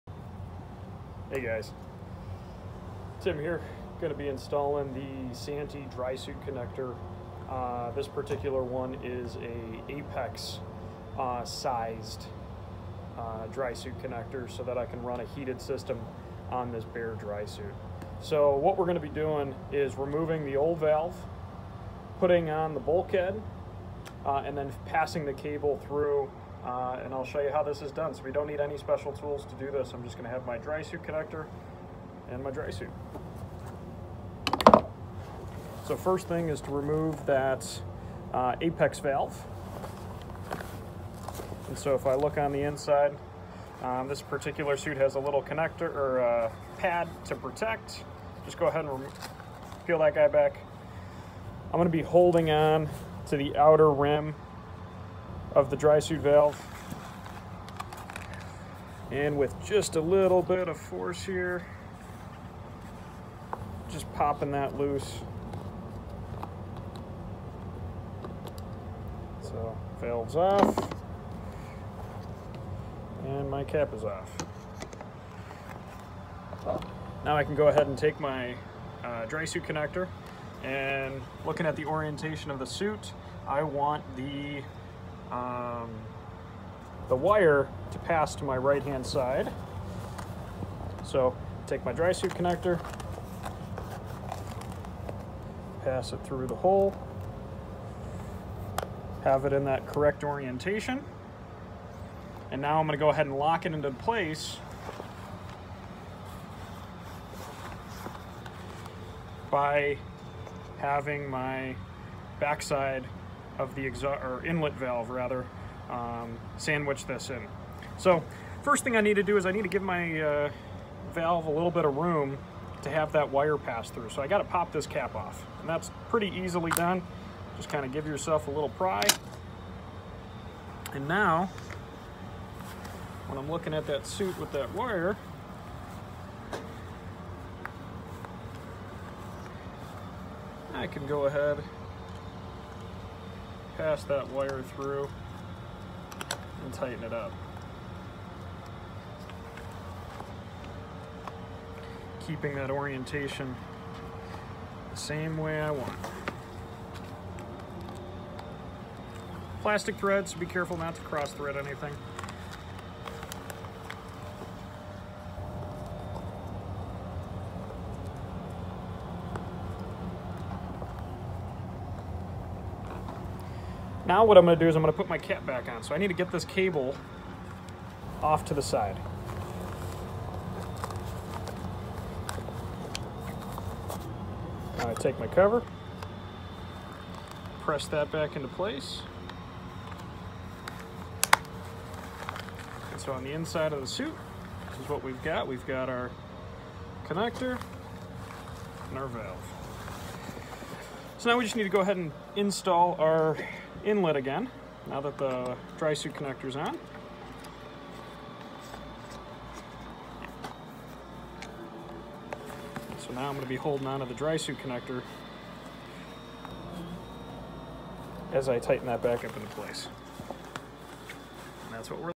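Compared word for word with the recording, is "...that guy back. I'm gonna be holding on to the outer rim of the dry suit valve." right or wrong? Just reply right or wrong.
right.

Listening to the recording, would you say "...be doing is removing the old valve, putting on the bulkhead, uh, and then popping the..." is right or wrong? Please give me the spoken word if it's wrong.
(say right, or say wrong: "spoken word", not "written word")
wrong: "passing", not "popping".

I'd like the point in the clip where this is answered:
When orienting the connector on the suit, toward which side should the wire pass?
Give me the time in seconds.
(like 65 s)
88 s.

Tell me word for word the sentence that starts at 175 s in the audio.
So I need to get this cable off to the side.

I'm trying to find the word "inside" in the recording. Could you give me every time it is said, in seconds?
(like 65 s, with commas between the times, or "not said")
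42 s, 193 s.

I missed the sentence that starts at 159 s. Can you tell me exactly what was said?
Plastic threads, be careful not to cross thread anything.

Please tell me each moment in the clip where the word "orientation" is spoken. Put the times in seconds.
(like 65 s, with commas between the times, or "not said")
81 s, 100 s, 152 s.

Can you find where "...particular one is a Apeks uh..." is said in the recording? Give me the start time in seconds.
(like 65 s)
8 s.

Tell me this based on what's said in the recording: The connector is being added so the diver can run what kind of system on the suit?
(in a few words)
heated system.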